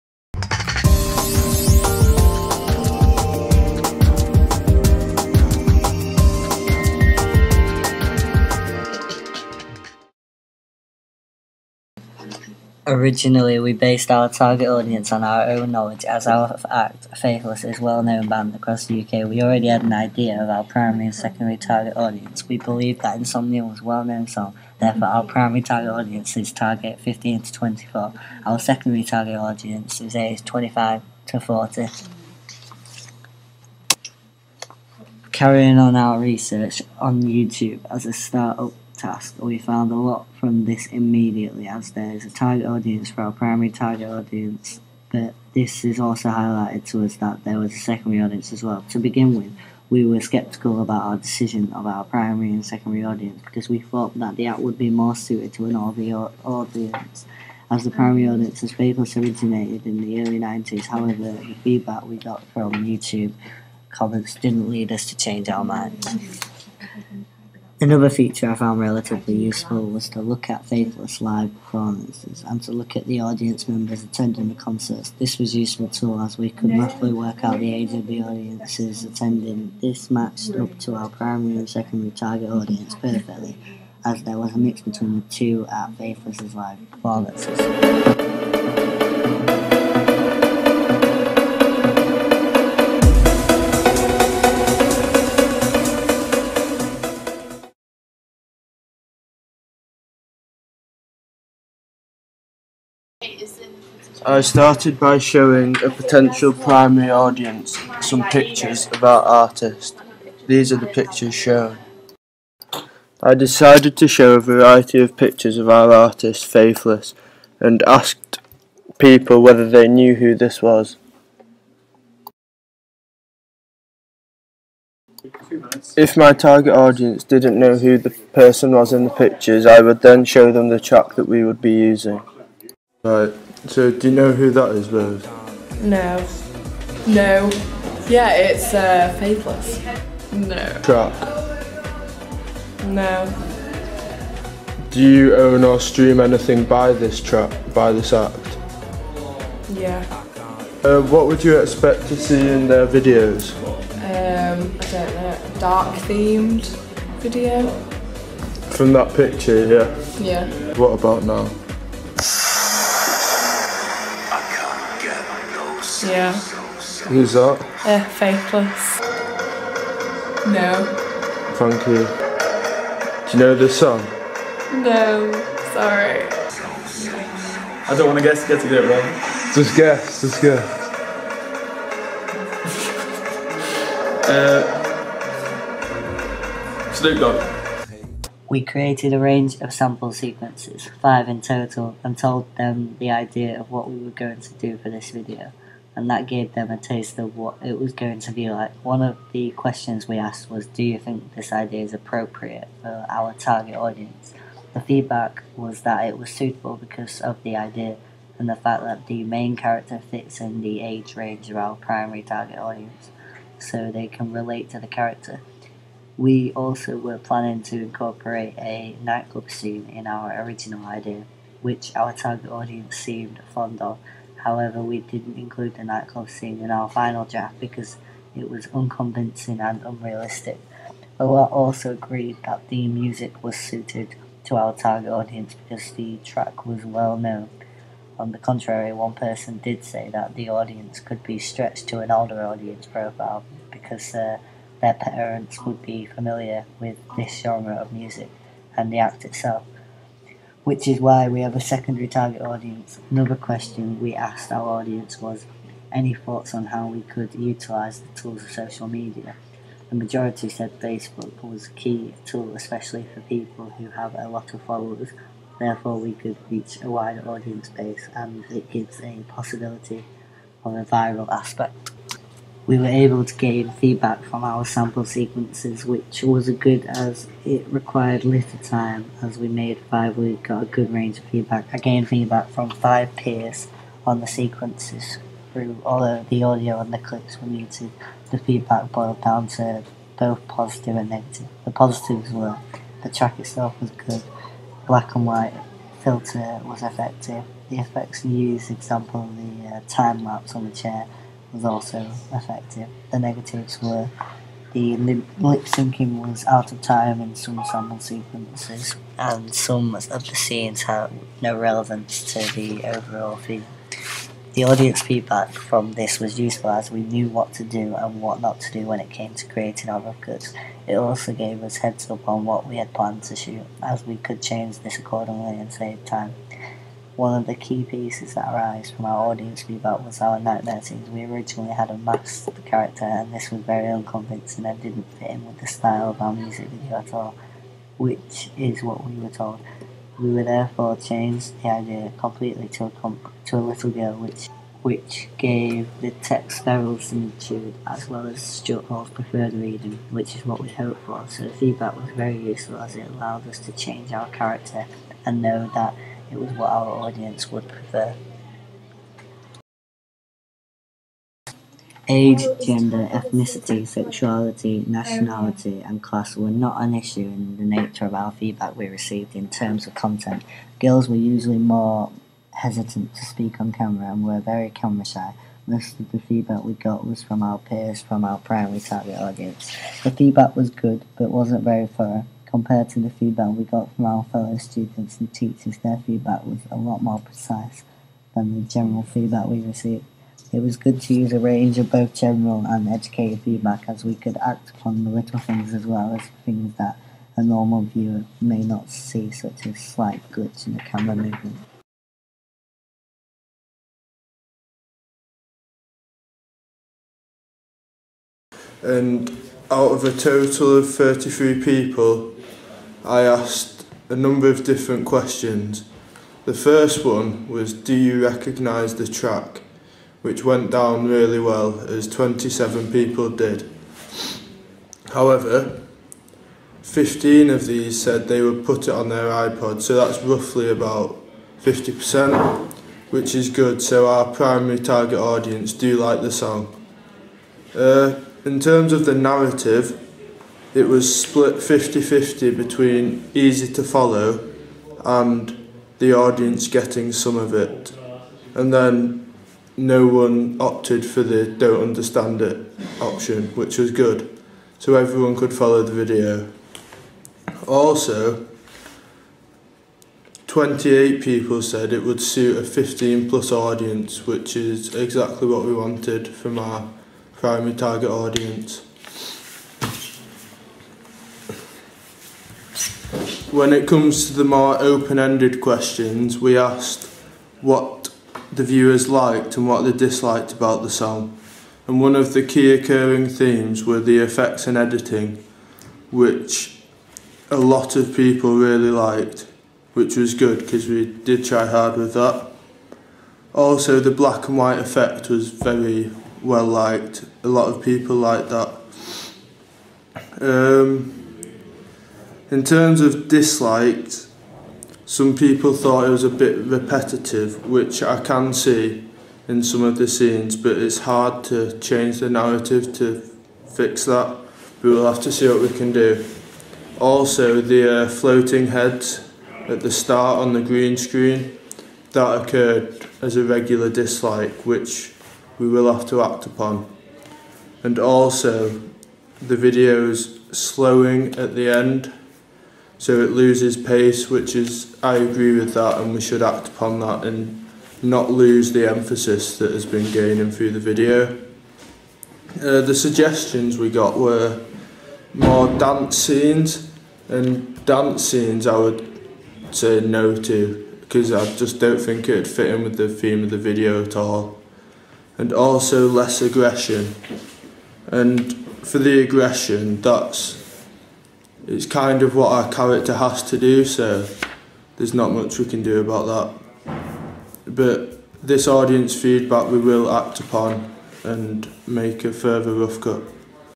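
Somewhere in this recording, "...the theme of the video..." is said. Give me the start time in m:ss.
9:12.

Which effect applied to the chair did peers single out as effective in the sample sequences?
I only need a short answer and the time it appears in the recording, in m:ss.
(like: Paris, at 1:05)
time lapse, at 4:59.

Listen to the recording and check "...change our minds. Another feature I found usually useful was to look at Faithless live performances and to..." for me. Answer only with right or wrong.
wrong.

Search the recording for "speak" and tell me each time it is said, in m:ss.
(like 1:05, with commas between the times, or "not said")
6:13.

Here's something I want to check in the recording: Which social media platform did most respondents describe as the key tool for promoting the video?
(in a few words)
Facebook.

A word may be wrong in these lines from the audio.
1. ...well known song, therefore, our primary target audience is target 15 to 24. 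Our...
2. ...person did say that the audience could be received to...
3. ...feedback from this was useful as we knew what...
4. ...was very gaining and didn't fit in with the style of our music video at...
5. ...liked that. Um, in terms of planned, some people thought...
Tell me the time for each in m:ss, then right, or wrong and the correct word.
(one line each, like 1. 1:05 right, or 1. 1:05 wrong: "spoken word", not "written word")
1. 0:23 right
2. 3:59 wrong: "stretched", not "received"
3. 5:15 right
4. 5:33 wrong: "unconvincing", not "gaining"
5. 8:18 wrong: "disliked", not "planned".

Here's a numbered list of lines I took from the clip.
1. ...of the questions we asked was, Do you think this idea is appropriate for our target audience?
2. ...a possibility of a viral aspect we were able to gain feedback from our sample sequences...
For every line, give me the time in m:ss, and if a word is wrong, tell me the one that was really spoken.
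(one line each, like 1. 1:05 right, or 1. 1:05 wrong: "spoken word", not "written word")
1. 3:19 right
2. 4:29 right.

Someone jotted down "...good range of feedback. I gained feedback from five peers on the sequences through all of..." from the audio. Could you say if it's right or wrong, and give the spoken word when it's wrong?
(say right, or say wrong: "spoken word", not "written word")
right.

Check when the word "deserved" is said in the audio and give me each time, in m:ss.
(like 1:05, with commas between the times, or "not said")
not said.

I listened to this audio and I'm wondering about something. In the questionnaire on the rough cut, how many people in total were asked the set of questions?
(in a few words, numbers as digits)
33.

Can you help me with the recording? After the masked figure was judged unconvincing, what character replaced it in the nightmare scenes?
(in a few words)
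a little girl.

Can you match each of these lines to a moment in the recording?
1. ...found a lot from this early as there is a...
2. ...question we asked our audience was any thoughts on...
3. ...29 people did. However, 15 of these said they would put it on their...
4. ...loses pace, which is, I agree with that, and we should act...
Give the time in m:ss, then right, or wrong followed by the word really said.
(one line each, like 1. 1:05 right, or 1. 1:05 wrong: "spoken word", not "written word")
1. 0:39 wrong: "immediately", not "early"
2. 4:13 right
3. 7:02 wrong: "27", not "29"
4. 8:53 right.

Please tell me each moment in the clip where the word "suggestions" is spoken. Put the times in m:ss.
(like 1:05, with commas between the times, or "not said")
9:02.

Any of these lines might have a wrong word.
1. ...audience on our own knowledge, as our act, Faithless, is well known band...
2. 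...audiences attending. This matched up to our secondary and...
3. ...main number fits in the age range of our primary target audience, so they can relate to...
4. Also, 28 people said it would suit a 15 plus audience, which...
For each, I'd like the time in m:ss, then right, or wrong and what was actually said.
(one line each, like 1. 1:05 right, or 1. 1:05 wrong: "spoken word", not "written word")
1. 0:14 right
2. 1:18 wrong: "primary", not "secondary"
3. 3:29 wrong: "character", not "number"
4. 7:37 right.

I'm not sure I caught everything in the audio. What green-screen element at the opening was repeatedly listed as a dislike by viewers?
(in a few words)
floating heads.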